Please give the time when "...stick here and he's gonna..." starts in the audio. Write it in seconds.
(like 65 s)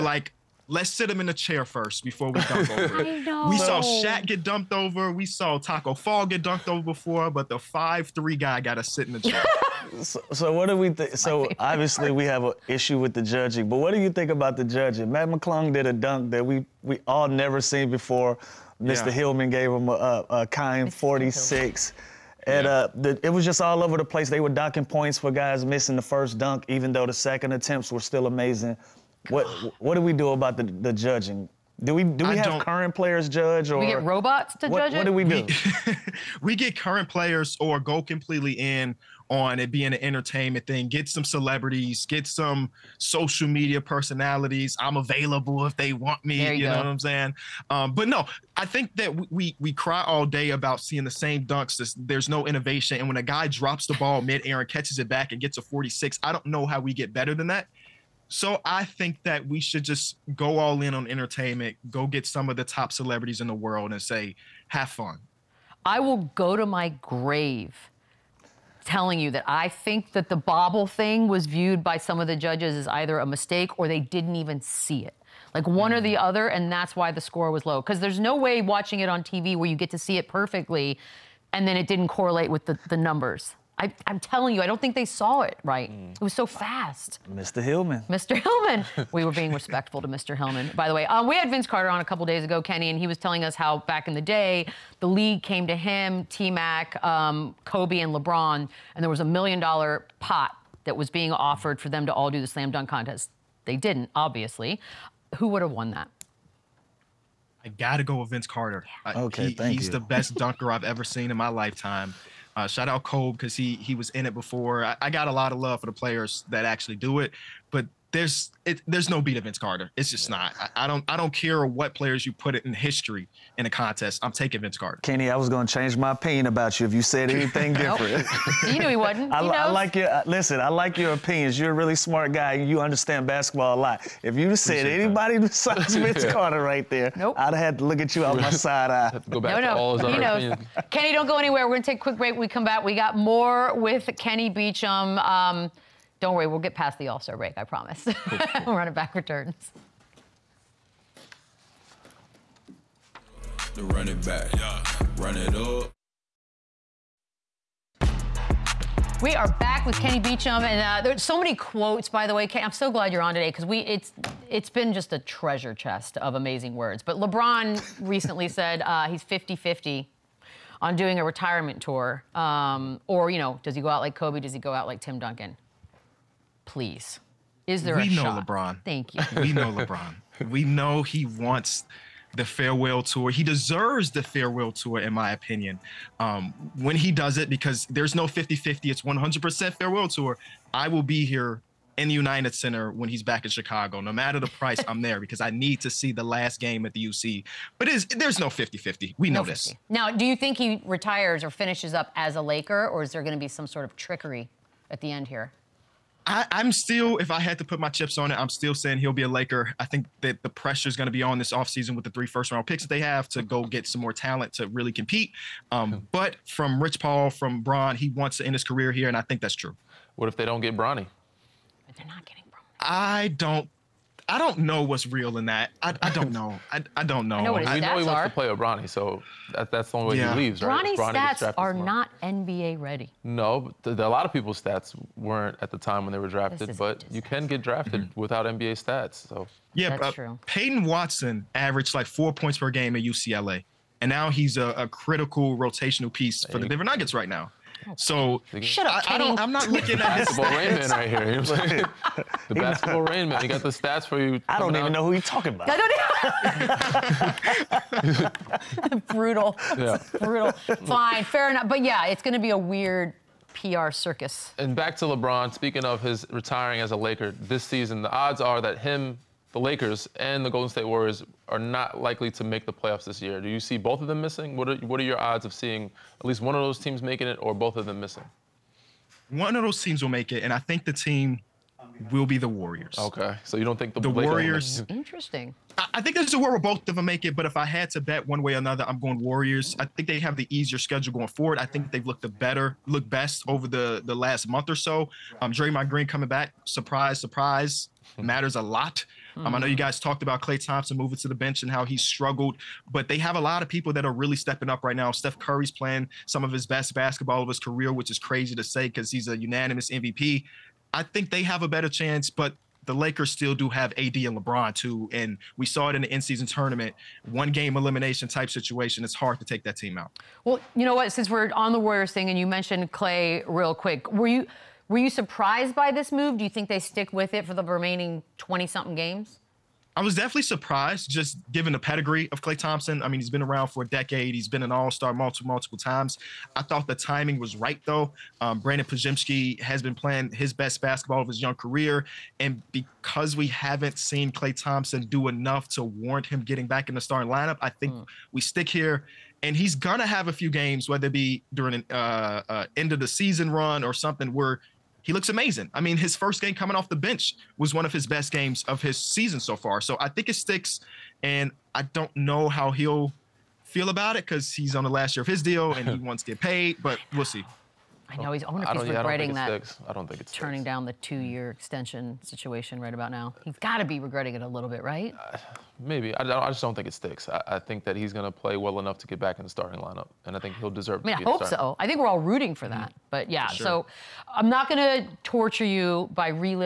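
348 s.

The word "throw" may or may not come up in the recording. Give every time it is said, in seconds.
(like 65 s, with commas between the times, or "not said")
not said.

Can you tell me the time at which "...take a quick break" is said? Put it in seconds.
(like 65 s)
141 s.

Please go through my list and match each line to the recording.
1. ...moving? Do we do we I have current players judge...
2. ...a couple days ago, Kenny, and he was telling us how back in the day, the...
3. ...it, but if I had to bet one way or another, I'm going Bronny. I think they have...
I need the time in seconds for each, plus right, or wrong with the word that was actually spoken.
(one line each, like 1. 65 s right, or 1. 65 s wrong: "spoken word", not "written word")
1. 30 s wrong: "judging", not "moving"
2. 91 s right
3. 287 s wrong: "Warriors", not "Bronny".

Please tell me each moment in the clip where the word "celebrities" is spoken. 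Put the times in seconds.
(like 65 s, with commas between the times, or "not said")
41 s, 62 s.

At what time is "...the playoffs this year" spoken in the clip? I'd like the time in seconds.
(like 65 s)
272 s.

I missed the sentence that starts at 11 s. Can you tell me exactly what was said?
So obviously we have an issue with the judging, but what do you think about the judging?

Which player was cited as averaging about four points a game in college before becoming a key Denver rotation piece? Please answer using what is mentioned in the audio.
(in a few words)
Peyton Watson.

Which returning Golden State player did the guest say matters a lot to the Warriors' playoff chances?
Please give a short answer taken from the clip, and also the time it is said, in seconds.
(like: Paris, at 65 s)
Draymond Green, at 295 s.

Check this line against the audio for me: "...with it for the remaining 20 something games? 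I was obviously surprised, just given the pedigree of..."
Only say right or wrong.
wrong.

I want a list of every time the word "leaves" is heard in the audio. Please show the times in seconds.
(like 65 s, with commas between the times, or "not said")
230 s.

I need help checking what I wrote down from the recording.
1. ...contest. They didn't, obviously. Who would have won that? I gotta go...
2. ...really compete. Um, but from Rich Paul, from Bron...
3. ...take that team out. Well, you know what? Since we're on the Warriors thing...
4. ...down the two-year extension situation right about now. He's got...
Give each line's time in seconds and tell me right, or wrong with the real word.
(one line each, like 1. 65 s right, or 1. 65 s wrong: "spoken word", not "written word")
1. 102 s right
2. 214 s right
3. 319 s right
4. 370 s right.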